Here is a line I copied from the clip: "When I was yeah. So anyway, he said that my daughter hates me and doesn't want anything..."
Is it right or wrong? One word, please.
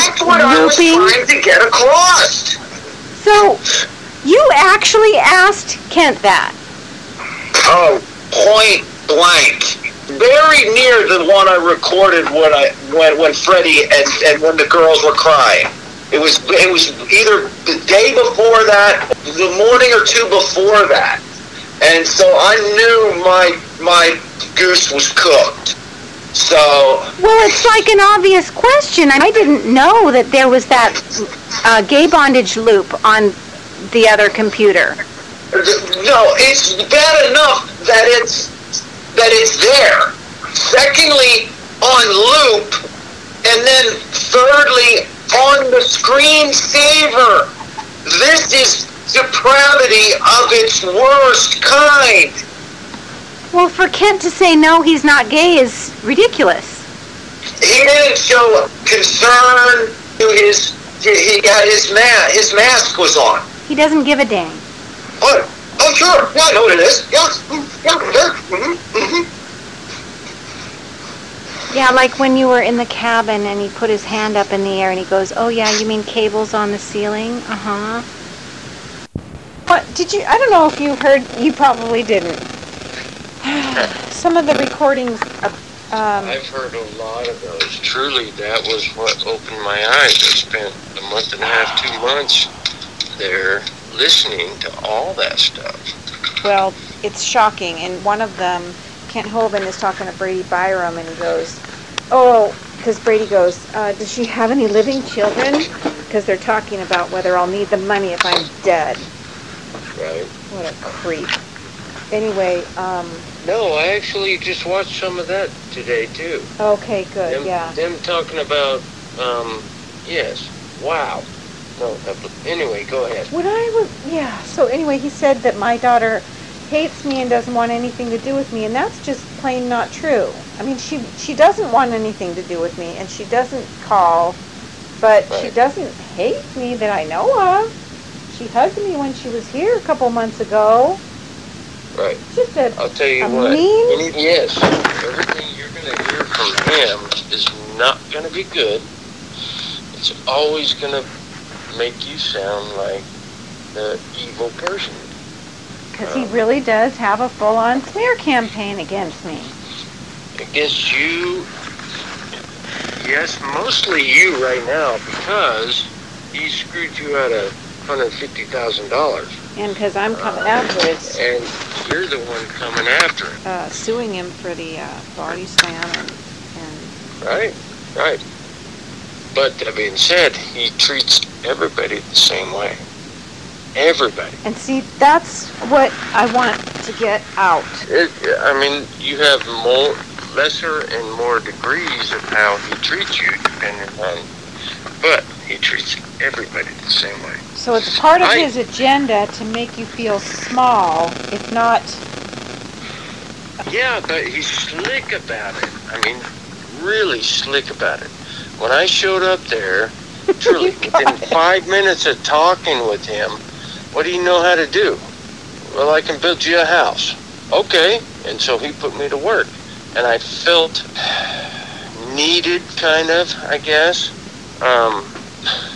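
right.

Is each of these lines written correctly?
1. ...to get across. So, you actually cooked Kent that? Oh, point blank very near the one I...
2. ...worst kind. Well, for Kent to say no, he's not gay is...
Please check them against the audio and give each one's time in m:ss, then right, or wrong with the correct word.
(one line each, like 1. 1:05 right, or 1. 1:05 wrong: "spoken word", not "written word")
1. 0:01 wrong: "asked", not "cooked"
2. 0:50 right.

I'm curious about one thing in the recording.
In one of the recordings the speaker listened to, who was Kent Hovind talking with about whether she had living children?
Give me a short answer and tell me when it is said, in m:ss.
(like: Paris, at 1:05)
Brady Byrum, at 1:40.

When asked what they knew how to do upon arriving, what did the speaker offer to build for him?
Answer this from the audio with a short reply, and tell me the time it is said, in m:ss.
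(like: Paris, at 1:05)
A house, at 3:36.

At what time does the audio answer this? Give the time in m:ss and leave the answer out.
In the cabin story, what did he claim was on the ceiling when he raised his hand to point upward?
1:16.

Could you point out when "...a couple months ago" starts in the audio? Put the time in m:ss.
2:19.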